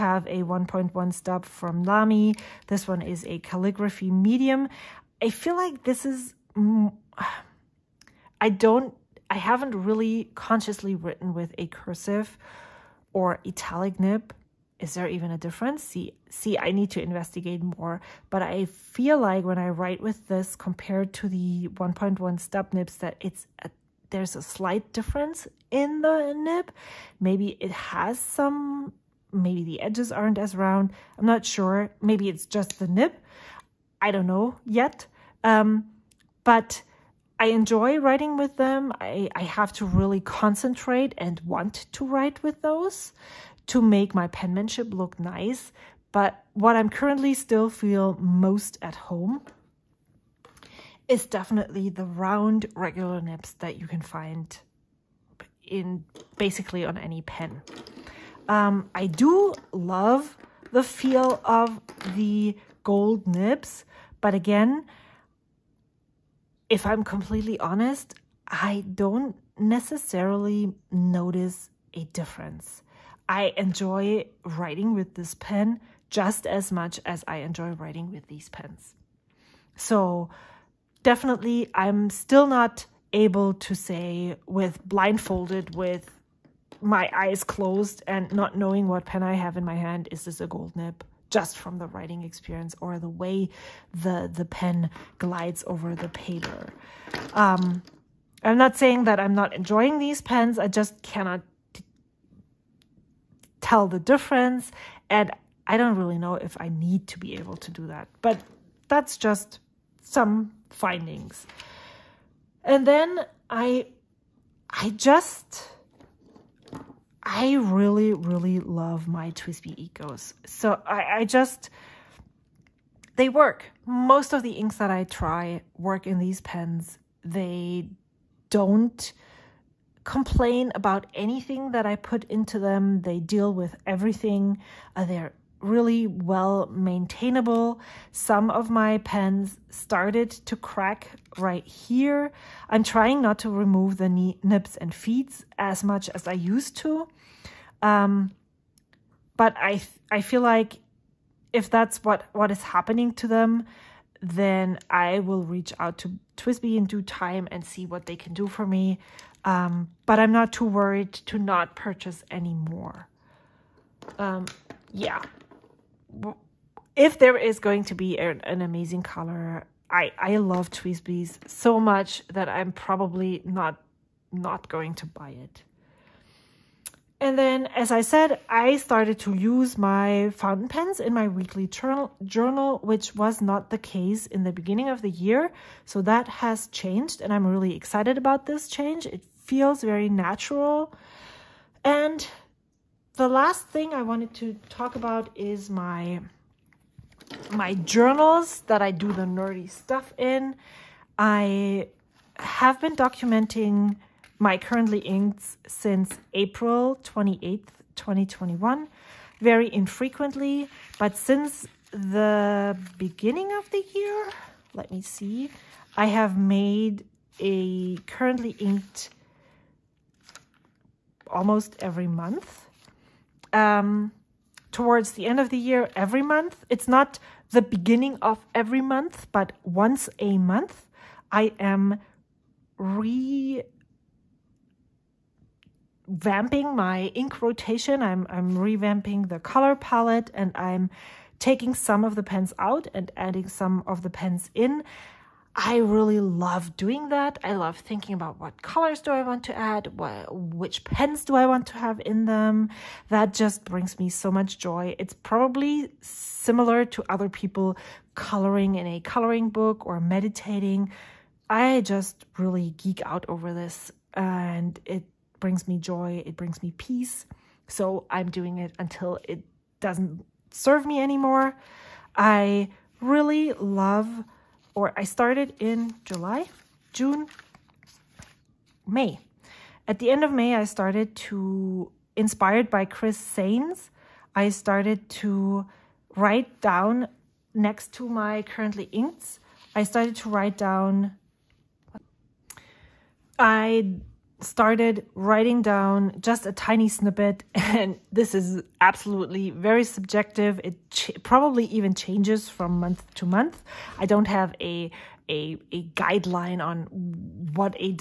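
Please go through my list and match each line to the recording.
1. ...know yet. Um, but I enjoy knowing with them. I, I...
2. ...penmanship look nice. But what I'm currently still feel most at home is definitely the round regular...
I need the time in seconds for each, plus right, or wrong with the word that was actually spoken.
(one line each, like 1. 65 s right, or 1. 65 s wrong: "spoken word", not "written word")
1. 34 s wrong: "writing", not "knowing"
2. 44 s right.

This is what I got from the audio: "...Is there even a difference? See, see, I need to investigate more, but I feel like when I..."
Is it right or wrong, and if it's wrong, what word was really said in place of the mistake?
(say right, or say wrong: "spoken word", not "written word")
right.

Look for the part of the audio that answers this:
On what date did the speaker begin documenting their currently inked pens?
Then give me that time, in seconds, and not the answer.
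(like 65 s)
206 s.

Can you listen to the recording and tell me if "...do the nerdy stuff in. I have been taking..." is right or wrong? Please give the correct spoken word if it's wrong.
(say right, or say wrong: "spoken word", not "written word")
wrong: "documenting", not "taking".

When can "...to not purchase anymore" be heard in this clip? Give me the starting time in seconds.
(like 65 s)
161 s.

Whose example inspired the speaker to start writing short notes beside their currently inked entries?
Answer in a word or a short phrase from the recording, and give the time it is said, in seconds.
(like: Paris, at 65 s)
Chris Sains, at 282 s.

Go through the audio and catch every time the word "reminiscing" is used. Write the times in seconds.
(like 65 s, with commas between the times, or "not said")
not said.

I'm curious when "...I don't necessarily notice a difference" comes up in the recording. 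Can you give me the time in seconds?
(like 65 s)
68 s.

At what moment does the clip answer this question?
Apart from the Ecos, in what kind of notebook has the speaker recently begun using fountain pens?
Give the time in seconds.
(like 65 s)
181 s.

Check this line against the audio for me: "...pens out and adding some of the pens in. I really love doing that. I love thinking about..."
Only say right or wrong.
right.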